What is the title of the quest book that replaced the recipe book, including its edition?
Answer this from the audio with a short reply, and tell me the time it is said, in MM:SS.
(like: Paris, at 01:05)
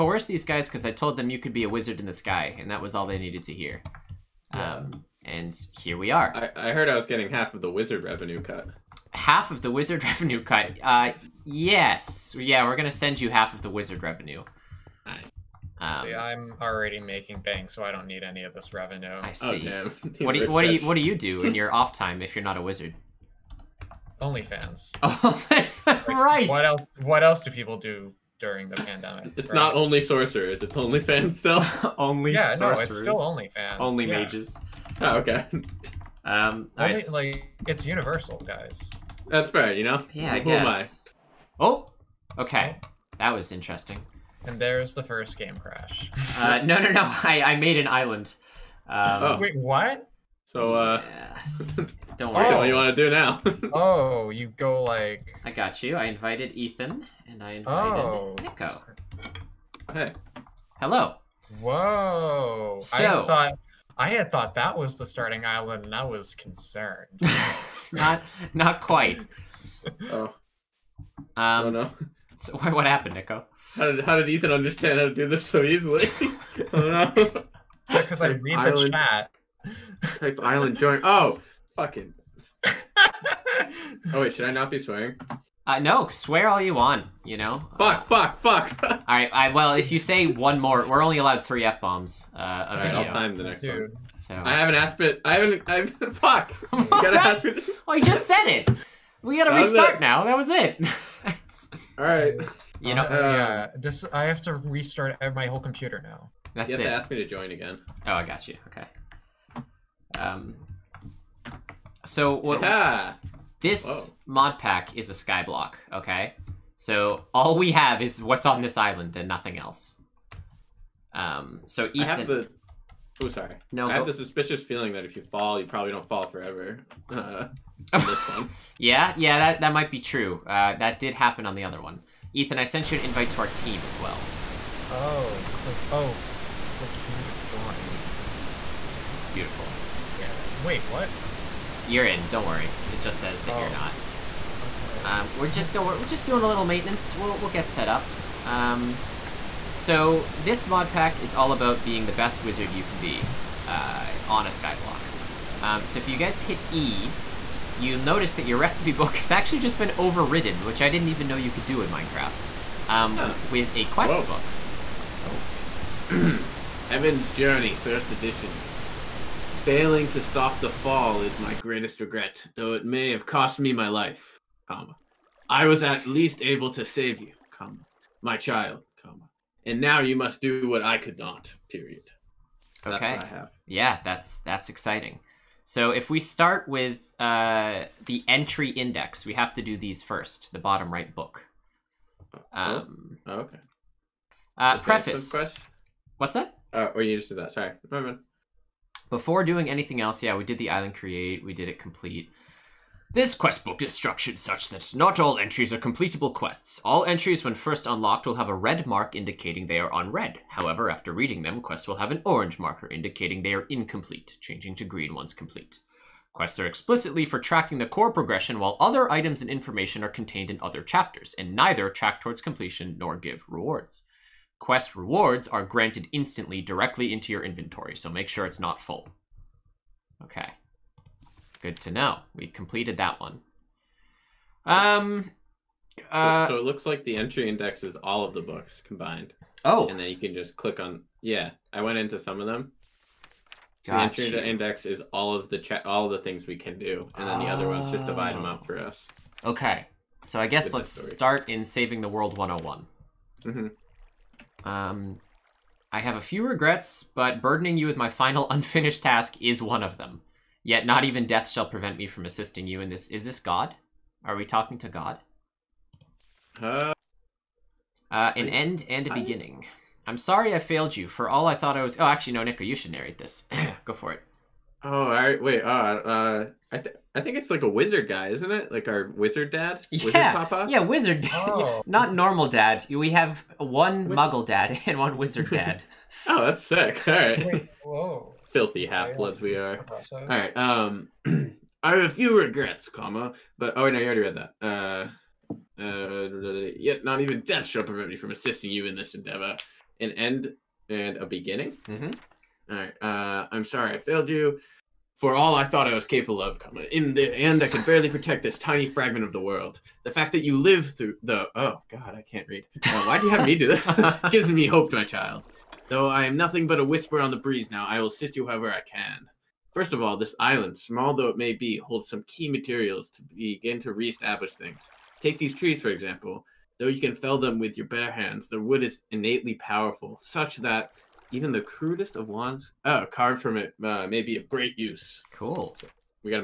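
Heaven's Journey, first edition, at 02:46.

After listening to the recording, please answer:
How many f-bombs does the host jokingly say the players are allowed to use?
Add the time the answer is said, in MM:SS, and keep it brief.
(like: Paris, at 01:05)
3, at 01:31.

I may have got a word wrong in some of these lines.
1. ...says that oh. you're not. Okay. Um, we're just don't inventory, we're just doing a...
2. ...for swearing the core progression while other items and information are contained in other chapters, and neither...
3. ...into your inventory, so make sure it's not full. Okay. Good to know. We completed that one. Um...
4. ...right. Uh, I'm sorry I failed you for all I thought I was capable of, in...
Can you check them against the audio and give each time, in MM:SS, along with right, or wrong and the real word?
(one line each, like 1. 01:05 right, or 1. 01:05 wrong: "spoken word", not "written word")
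1. 02:23 wrong: "worry", not "inventory"
2. 03:37 wrong: "tracking", not "swearing"
3. 03:47 right
4. 05:02 right.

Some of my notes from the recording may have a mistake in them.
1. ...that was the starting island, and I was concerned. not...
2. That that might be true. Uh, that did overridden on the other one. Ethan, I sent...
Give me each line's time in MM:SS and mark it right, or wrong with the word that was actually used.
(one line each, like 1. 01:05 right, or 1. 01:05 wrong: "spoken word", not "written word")
1. 01:04 right
2. 02:09 wrong: "happen", not "overridden".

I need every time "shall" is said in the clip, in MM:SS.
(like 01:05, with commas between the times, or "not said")
04:21, 04:57.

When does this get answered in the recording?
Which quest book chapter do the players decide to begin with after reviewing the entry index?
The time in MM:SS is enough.
04:11.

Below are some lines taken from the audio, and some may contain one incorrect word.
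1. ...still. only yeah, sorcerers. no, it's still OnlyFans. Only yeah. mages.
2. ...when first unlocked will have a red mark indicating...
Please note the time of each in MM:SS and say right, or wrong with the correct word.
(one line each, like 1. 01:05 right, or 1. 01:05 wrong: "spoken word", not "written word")
1. 00:31 right
2. 03:27 right.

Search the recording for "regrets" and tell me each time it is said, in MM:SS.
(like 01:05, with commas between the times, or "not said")
02:51, 04:16, 04:52.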